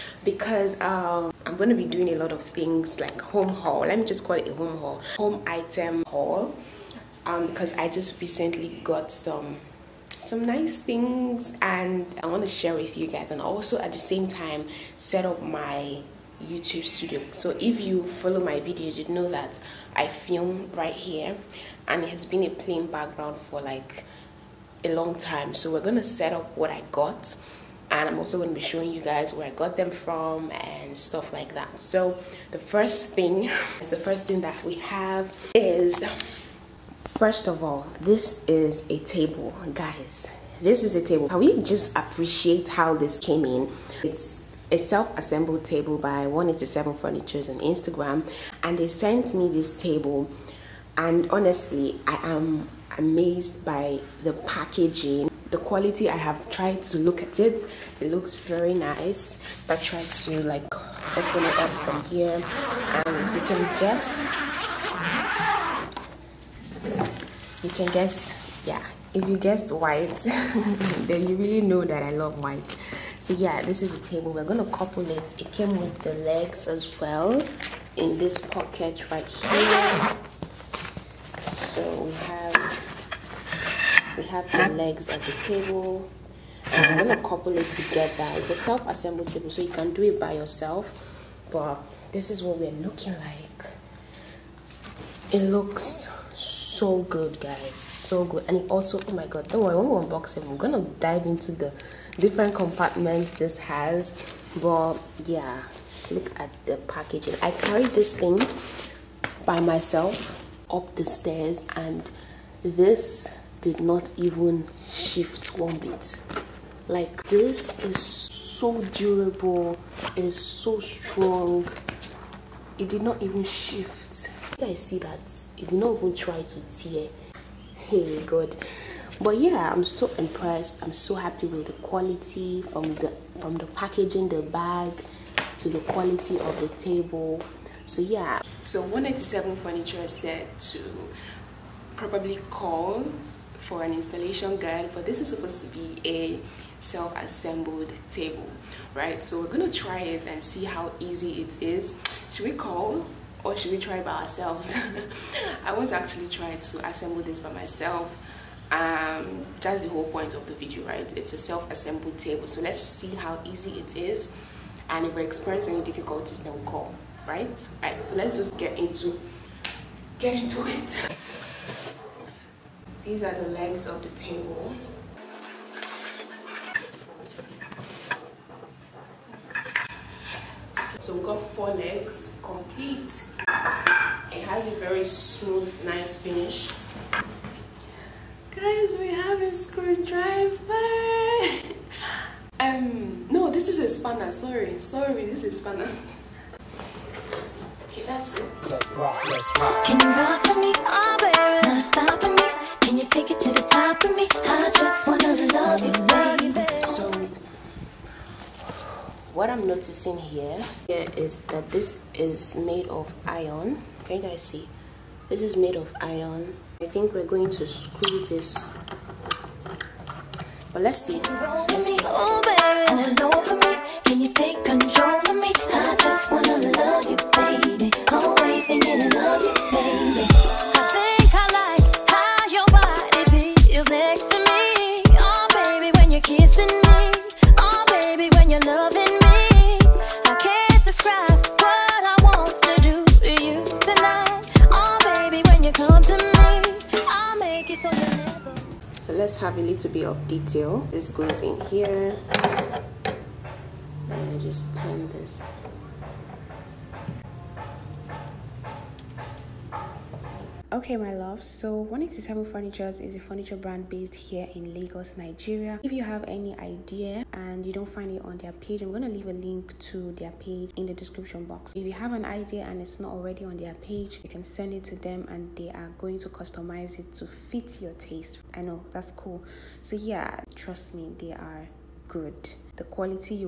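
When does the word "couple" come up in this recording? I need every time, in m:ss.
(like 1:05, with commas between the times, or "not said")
1:14, 1:27.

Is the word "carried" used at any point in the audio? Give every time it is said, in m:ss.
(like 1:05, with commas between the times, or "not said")
1:47.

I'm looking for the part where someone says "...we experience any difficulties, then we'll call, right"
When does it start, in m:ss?
2:45.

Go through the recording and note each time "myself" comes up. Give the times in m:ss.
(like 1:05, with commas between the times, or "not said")
1:49, 2:37.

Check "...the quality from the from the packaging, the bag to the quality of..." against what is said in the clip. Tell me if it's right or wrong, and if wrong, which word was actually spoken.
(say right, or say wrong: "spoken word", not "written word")
right.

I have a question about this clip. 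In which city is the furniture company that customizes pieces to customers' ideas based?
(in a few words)
Lagos, Nigeria.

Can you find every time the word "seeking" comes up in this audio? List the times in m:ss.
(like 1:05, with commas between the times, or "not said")
not said.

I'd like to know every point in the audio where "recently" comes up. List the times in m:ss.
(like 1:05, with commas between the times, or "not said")
0:08.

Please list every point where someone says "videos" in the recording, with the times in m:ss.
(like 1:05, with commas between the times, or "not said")
0:18, 2:40.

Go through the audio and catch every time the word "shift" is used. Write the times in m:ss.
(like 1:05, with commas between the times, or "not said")
1:54, 2:03.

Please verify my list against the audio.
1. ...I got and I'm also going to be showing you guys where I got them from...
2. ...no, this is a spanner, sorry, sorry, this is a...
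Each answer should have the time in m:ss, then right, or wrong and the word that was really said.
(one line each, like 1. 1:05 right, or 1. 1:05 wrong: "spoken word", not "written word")
1. 0:26 right
2. 3:13 right.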